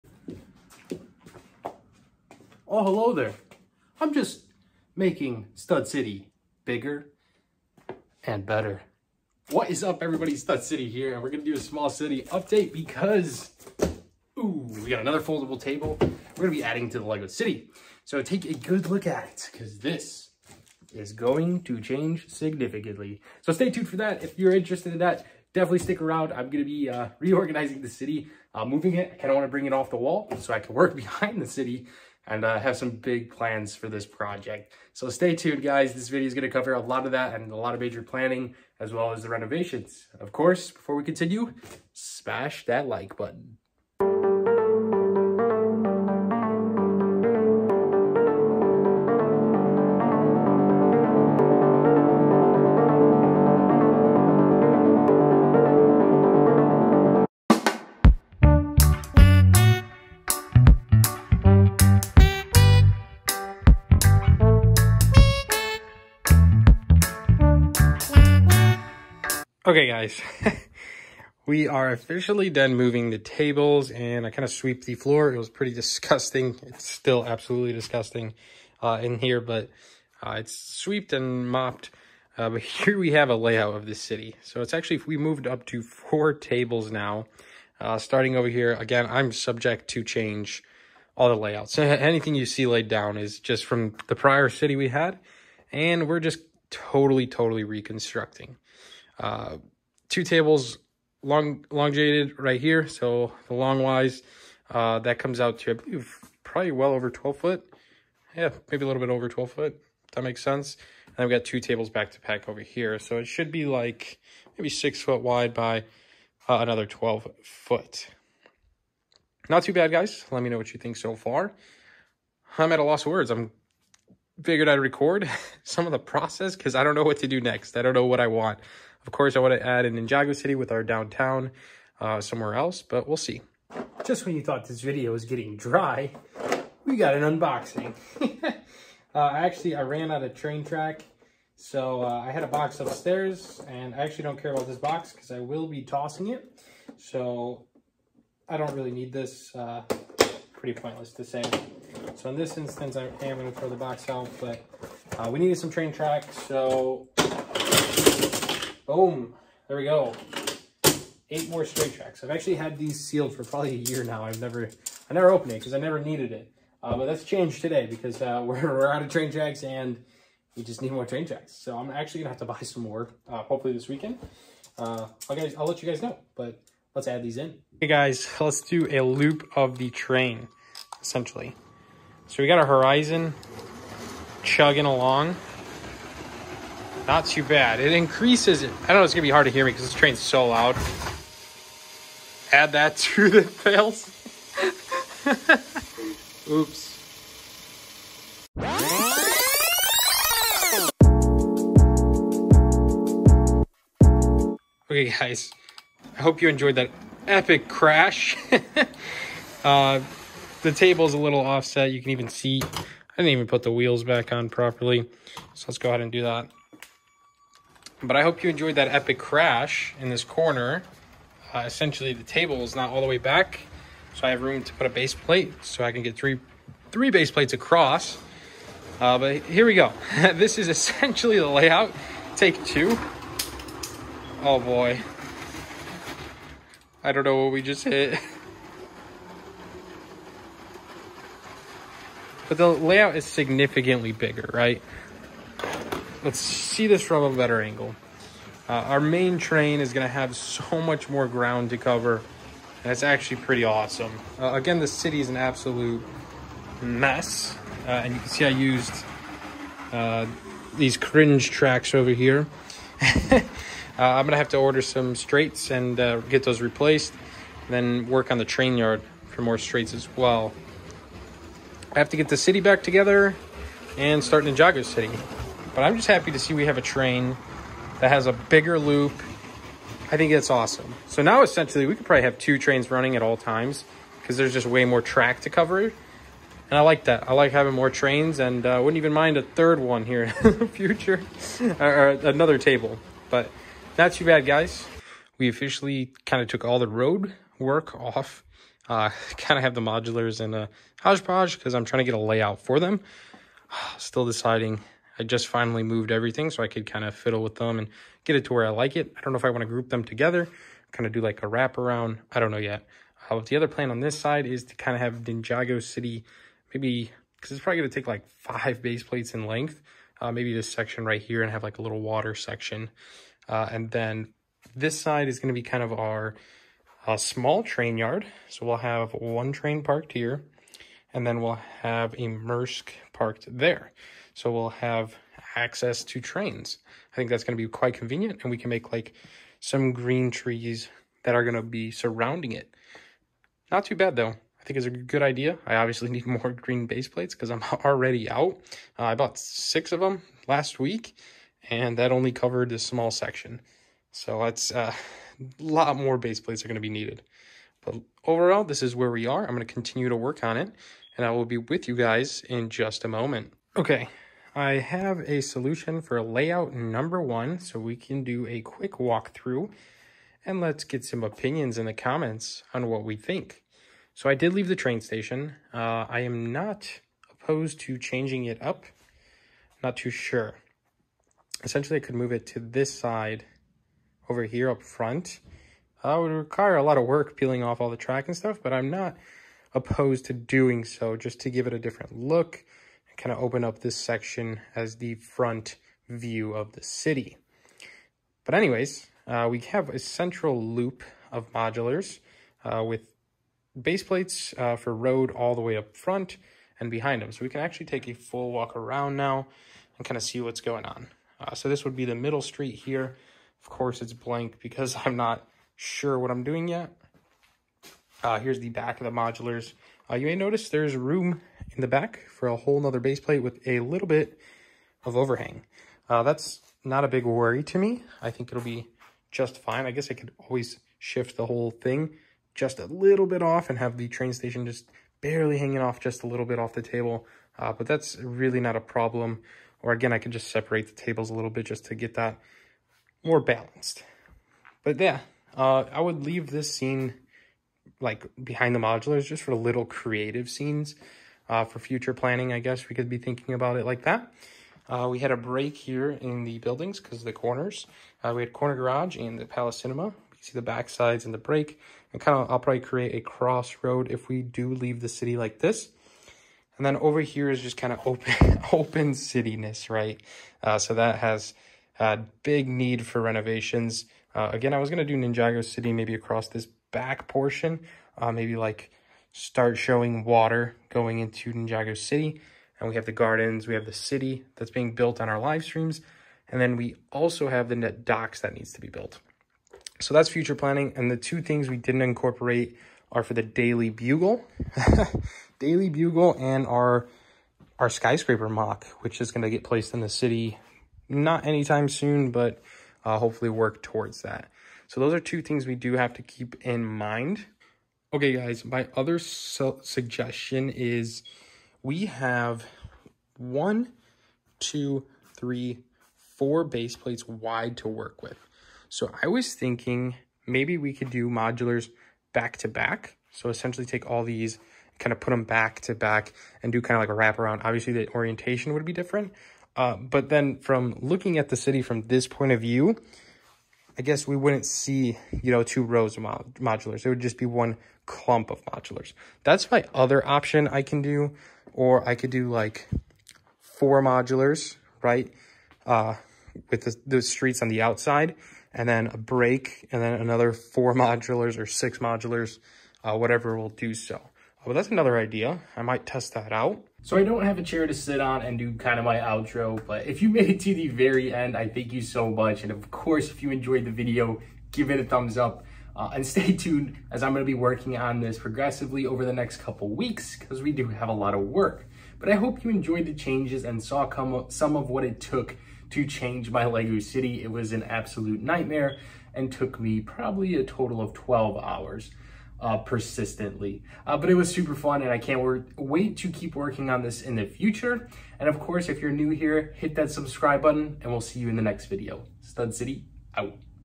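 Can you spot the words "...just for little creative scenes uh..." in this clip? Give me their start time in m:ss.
7:29.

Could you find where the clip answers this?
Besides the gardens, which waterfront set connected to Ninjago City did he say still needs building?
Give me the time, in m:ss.
8:07.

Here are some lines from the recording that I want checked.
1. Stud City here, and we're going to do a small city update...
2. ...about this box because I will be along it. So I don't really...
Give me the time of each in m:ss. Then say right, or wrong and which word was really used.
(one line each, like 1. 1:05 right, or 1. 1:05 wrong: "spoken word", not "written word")
1. 0:10 right
2. 2:24 wrong: "tossing", not "along".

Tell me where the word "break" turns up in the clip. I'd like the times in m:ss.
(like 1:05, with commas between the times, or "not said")
7:35, 7:41, 9:09.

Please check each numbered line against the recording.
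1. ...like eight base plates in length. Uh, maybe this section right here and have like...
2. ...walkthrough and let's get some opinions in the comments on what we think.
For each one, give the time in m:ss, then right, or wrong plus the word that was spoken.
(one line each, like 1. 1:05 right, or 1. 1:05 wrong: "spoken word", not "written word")
1. 5:18 wrong: "five", not "eight"
2. 6:08 right.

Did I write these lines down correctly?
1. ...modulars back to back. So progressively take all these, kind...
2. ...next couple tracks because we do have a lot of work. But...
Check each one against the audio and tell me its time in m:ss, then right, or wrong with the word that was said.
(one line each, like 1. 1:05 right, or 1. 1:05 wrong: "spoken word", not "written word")
1. 8:41 wrong: "essentially", not "progressively"
2. 9:29 wrong: "weeks", not "tracks".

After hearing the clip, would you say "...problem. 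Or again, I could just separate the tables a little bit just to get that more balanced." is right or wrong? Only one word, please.
right.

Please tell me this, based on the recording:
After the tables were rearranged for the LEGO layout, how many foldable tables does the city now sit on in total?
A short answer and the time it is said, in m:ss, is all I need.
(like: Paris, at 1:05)
4, at 1:25.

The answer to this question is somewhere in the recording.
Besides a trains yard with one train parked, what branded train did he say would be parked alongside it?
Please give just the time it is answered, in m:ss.
5:32.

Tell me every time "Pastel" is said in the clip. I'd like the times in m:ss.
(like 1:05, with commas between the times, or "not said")
not said.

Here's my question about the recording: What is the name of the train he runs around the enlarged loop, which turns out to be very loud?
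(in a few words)
Horizon.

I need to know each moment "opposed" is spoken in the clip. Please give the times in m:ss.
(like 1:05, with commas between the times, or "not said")
6:17, 6:29.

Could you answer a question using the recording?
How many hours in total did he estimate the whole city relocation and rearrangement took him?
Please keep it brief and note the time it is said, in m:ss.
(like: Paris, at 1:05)
12, at 9:41.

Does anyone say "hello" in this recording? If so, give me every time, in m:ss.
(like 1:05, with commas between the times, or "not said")
0:02.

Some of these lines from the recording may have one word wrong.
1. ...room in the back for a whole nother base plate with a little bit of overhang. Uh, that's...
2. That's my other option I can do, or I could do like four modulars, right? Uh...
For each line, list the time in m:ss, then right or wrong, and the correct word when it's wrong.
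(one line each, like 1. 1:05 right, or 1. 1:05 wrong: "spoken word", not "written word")
1. 7:00 right
2. 8:59 right.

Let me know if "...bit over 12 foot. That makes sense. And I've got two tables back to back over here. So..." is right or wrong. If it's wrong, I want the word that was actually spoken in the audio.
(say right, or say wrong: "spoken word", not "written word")
right.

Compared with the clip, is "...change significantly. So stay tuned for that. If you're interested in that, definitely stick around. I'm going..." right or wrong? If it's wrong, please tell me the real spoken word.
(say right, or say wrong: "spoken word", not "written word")
right.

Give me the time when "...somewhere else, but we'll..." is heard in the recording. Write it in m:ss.
2:12.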